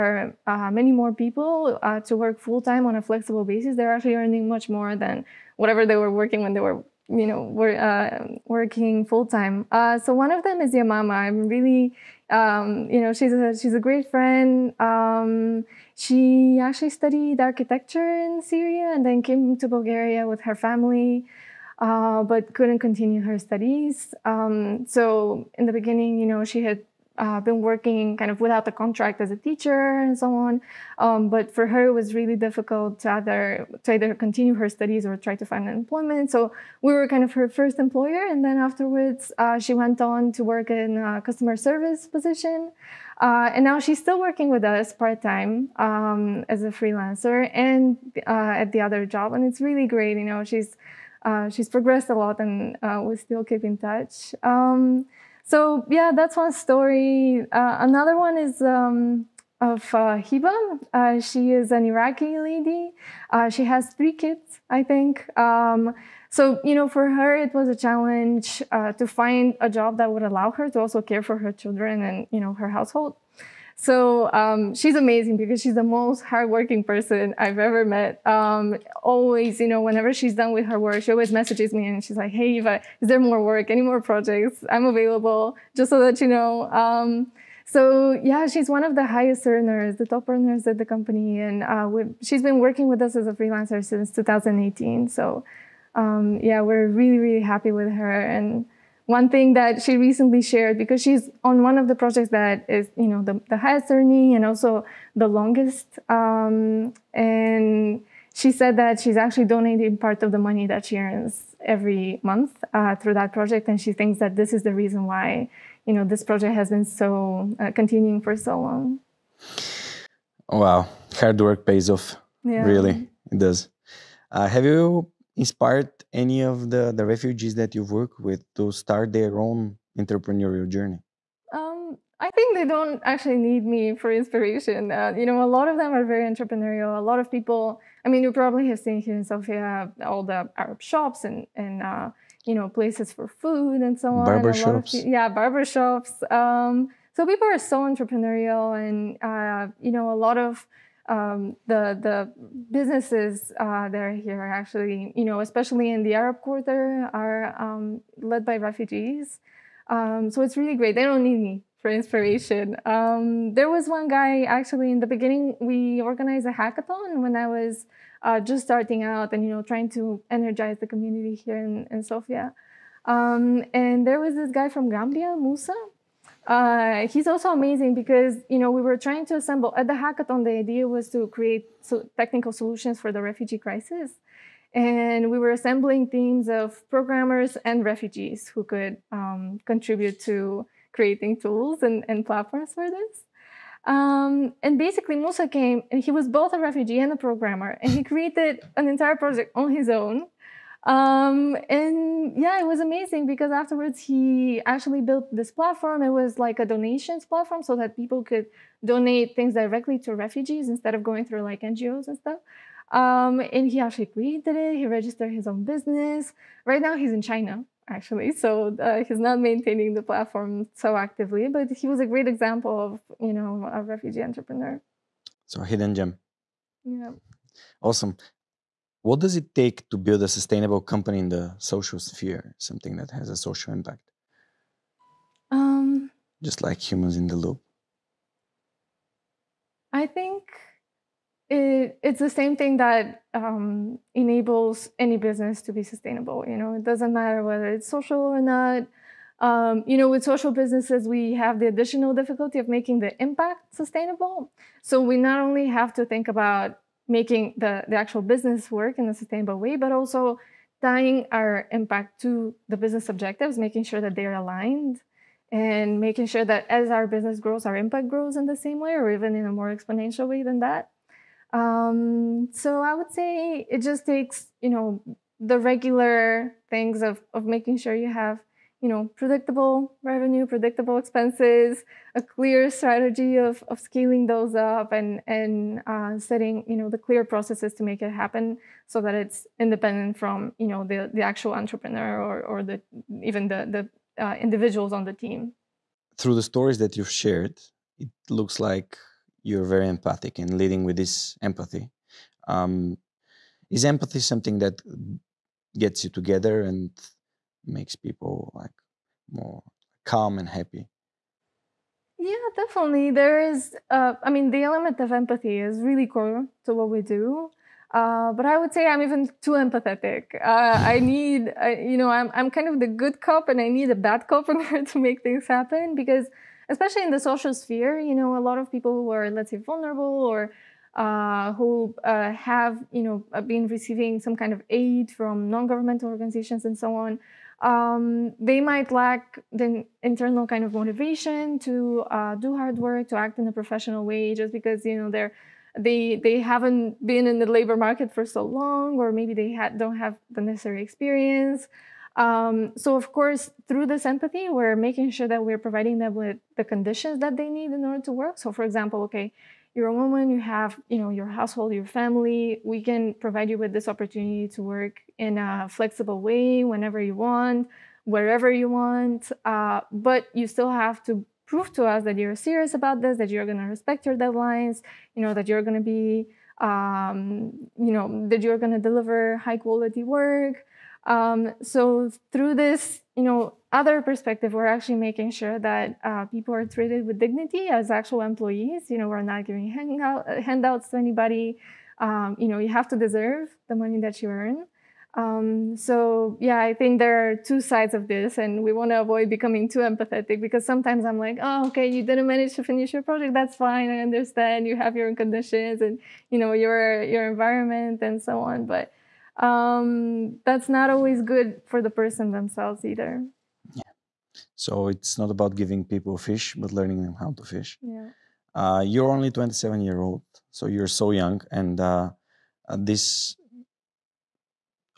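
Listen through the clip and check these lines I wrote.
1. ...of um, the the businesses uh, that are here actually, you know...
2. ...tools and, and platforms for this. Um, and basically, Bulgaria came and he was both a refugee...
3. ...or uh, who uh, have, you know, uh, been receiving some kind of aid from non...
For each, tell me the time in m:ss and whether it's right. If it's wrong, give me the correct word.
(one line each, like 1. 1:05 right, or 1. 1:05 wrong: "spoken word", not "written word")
1. 2:30 right
2. 3:11 wrong: "Musa", not "Bulgaria"
3. 5:30 right.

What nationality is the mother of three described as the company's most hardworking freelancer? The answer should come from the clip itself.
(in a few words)
Iraqi.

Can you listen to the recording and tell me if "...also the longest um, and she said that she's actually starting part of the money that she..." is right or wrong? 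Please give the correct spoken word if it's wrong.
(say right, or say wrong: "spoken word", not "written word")
wrong: "donating", not "starting".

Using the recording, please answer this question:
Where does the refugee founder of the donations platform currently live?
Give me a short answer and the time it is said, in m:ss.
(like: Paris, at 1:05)
China, at 3:37.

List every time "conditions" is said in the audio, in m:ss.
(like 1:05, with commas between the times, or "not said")
5:56, 6:45.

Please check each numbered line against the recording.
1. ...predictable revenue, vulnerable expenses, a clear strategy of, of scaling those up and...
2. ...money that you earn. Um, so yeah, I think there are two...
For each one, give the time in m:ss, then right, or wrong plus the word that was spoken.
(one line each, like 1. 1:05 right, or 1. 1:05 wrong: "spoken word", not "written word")
1. 4:39 wrong: "predictable", not "vulnerable"
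2. 6:33 right.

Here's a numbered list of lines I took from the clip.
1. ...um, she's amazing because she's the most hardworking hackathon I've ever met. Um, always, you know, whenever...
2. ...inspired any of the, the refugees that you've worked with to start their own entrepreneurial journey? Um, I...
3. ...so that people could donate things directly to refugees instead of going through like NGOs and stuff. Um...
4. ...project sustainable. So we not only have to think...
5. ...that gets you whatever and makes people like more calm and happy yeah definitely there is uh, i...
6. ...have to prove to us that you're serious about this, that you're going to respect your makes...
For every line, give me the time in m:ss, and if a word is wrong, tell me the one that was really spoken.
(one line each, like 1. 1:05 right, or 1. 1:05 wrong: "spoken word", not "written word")
1. 1:14 wrong: "person", not "hackathon"
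2. 2:05 right
3. 3:27 right
4. 4:13 wrong: "impact", not "project"
5. 5:04 wrong: "together", not "whatever"
6. 6:10 wrong: "deadlines", not "makes".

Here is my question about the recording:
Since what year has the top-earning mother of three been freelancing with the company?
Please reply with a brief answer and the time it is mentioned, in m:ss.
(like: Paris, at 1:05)
2018, at 1:34.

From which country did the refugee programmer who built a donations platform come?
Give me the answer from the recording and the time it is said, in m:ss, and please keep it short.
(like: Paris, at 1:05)
Gambia, at 2:54.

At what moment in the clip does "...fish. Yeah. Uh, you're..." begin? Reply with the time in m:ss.
6:57.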